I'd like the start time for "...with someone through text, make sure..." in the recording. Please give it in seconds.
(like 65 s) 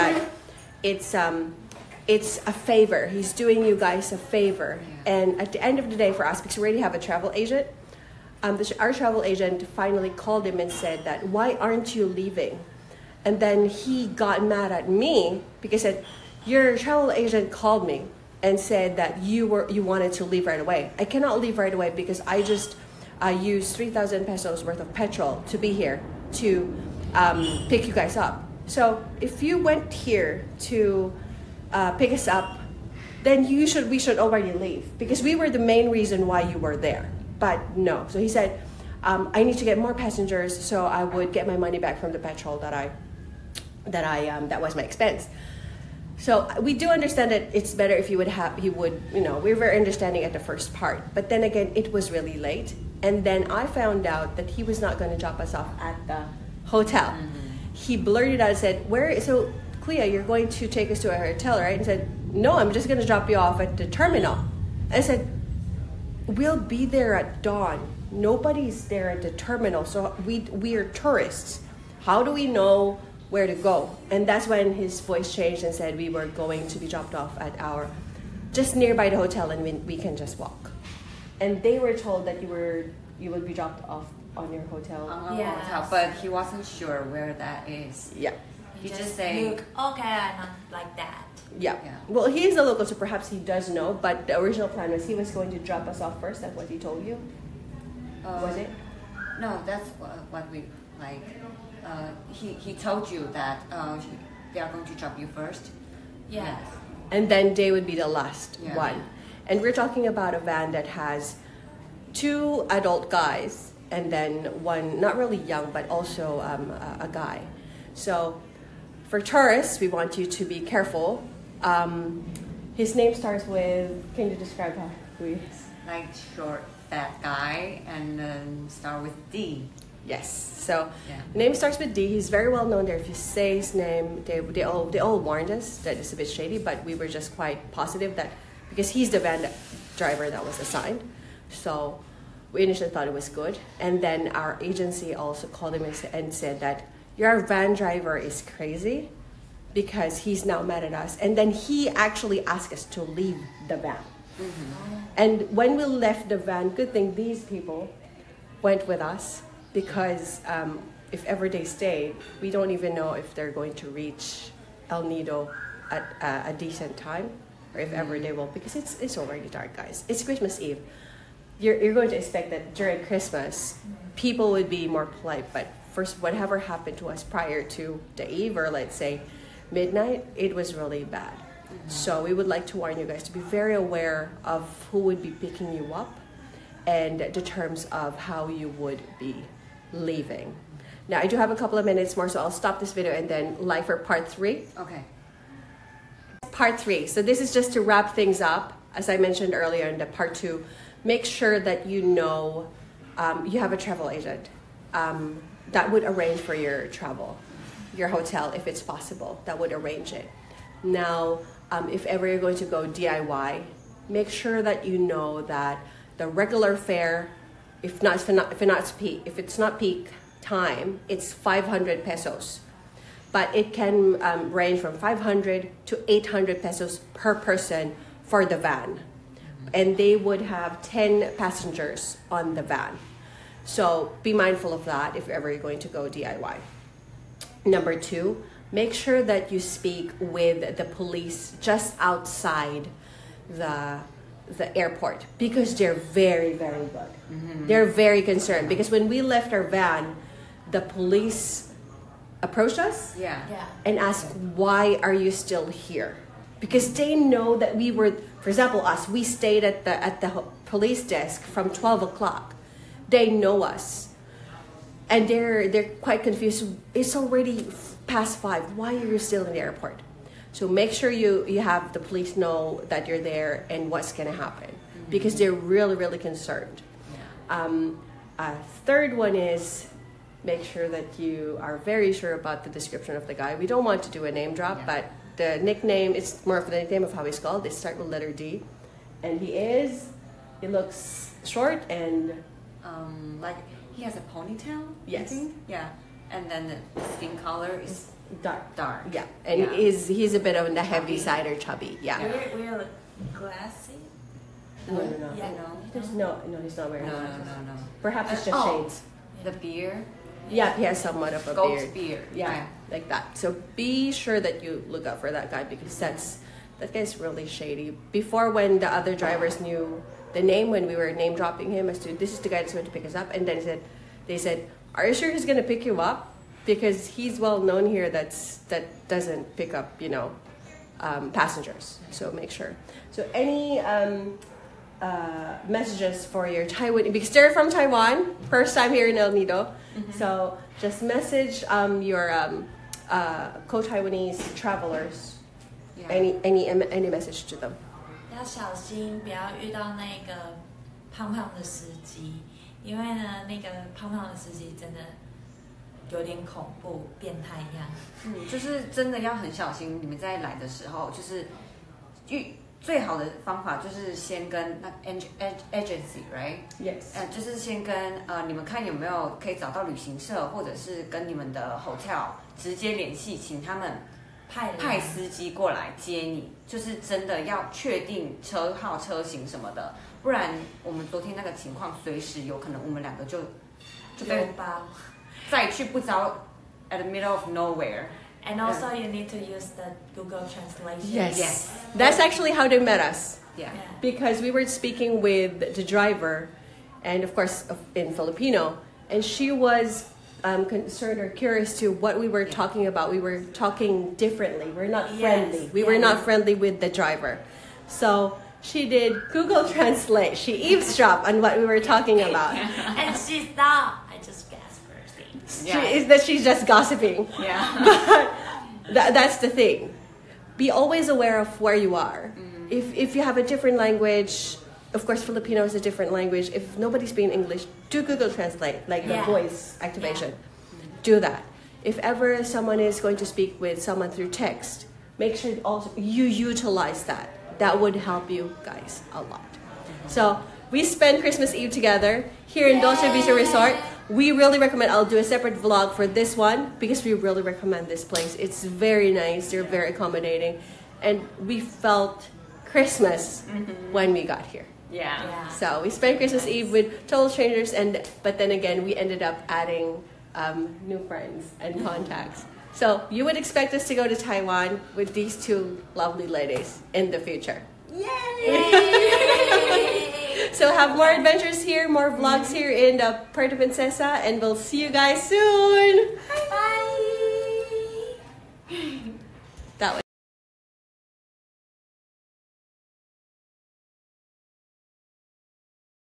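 433 s.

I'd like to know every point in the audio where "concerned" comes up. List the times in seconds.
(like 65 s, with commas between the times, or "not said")
248 s, 276 s, 400 s.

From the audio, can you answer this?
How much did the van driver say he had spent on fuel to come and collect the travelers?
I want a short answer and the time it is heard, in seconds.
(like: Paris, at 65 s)
3,000 pesos, at 23 s.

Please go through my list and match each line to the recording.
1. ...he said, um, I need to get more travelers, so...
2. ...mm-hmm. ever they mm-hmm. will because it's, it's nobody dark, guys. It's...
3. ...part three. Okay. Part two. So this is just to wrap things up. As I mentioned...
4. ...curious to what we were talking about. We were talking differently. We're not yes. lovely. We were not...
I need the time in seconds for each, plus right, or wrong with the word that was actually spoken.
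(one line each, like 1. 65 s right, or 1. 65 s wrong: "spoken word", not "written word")
1. 38 s wrong: "passengers", not "travelers"
2. 167 s wrong: "already", not "nobody"
3. 193 s wrong: "three", not "two"
4. 401 s wrong: "friendly", not "lovely".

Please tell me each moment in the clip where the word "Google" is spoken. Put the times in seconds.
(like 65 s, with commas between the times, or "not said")
390 s, 409 s, 428 s.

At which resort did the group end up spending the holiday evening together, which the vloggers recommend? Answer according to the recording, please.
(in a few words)
Dolce Vita Resort.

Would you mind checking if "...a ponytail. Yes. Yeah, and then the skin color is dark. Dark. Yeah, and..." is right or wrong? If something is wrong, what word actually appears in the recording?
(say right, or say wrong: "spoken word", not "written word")
right.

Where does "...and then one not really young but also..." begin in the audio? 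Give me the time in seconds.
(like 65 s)
113 s.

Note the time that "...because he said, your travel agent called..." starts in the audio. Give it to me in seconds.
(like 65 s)
15 s.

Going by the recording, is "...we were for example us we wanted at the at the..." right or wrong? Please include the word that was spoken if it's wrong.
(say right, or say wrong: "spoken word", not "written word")
wrong: "stayed", not "wanted".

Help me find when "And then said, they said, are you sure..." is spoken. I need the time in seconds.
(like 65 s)
323 s.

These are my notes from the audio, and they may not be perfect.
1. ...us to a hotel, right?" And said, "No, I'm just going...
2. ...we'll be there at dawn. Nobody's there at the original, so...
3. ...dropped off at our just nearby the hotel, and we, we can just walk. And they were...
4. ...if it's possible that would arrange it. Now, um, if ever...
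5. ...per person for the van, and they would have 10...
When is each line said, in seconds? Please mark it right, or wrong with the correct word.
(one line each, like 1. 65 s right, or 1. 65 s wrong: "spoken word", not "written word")
1. 60 s right
2. 66 s wrong: "terminal", not "original"
3. 76 s right
4. 208 s right
5. 227 s right.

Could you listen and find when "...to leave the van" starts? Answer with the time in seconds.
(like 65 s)
152 s.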